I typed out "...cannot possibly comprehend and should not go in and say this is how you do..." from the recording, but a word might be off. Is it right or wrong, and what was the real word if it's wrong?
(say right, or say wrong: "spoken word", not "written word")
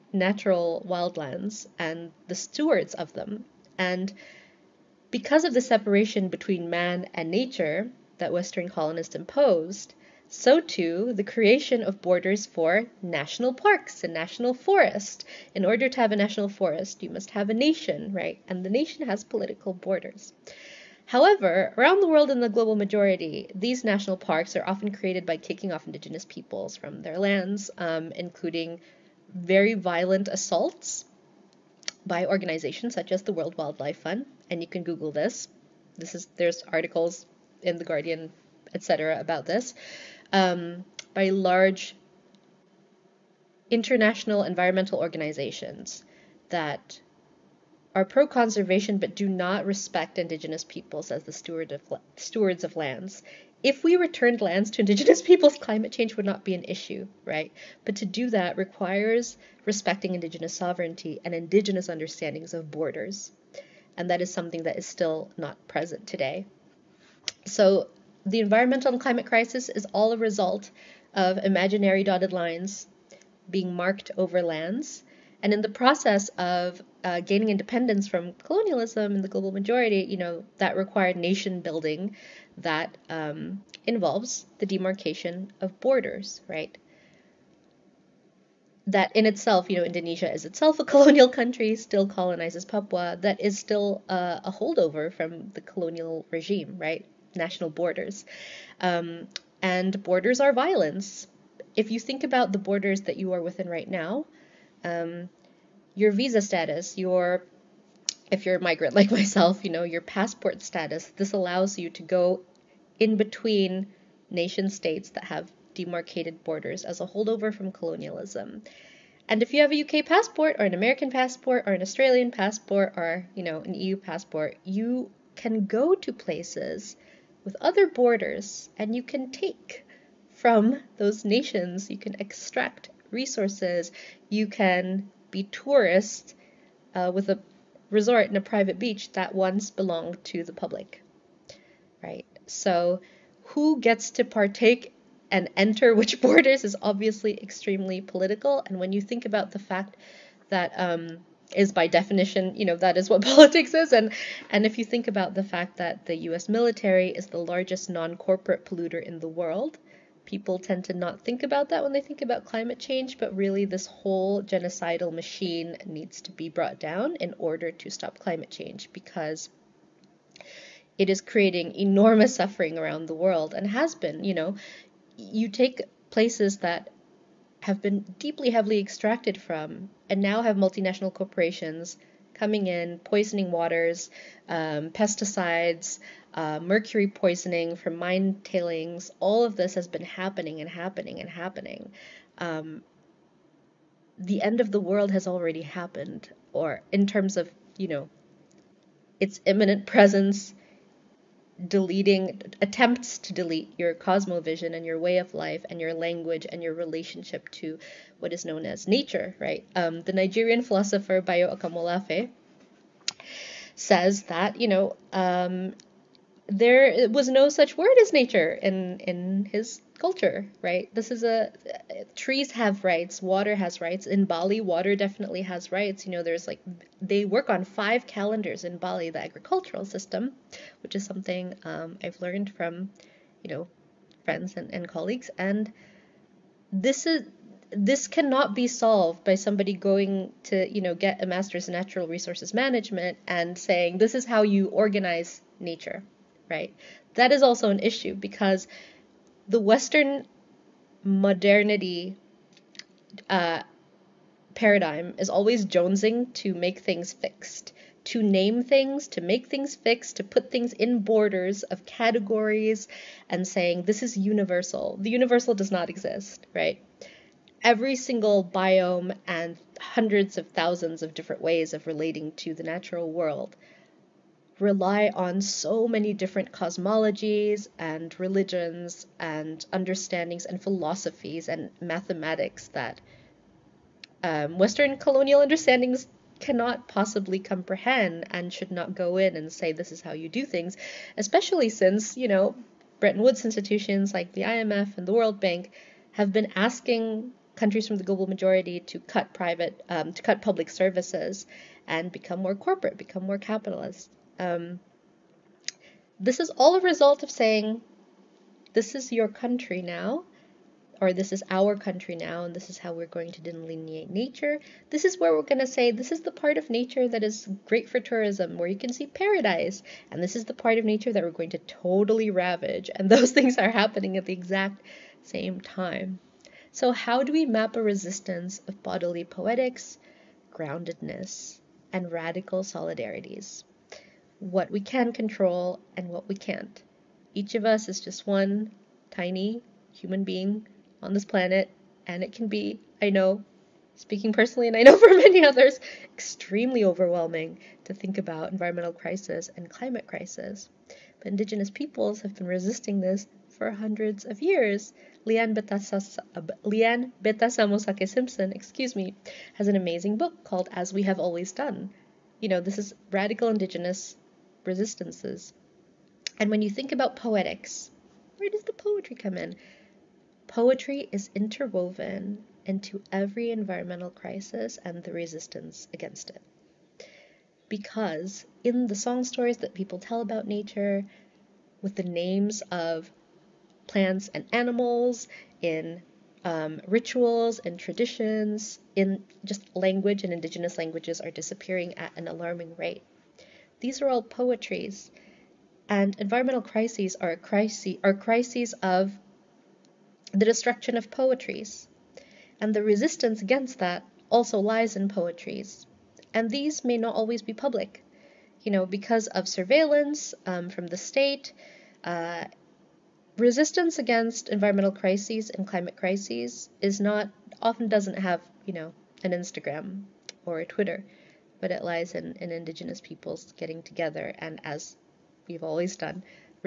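right.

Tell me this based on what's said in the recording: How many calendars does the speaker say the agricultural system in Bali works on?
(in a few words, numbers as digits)
5.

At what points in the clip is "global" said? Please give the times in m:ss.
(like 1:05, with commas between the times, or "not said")
0:22, 1:19, 4:58.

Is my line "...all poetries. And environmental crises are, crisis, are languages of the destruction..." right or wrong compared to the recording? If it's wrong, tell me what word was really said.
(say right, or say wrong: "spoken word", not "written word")
wrong: "crises", not "languages".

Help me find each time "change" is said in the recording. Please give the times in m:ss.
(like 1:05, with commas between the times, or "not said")
0:55, 2:42, 2:48.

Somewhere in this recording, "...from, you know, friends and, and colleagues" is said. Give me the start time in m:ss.
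3:52.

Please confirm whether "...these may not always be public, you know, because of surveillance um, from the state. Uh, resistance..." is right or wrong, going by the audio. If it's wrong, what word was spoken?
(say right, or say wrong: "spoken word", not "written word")
right.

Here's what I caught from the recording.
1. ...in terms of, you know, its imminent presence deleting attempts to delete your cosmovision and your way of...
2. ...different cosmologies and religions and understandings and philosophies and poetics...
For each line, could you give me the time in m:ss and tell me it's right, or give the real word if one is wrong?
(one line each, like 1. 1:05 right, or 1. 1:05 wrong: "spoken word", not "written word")
1. 3:16 right
2. 4:36 wrong: "mathematics", not "poetics".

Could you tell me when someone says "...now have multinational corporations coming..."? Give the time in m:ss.
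3:00.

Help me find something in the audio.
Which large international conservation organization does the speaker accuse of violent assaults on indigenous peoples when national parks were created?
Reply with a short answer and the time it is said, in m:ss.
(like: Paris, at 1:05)
World Wildlife Fund, at 0:33.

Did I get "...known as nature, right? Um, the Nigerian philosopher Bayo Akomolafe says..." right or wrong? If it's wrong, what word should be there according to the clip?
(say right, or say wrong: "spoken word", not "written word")
right.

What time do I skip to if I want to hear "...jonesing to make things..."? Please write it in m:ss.
4:15.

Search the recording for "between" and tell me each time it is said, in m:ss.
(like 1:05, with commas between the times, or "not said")
0:06, 1:53.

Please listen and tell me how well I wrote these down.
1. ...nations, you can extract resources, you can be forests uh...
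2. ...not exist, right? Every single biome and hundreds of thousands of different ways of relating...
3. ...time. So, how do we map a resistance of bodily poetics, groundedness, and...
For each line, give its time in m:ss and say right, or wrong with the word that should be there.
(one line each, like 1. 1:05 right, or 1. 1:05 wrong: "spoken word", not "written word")
1. 2:11 wrong: "tourists", not "forests"
2. 4:25 right
3. 5:25 right.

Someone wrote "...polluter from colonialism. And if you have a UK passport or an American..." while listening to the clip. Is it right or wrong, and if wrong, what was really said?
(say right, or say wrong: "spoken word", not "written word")
wrong: "holdover", not "polluter".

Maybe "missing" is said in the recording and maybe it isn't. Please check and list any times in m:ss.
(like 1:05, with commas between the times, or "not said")
not said.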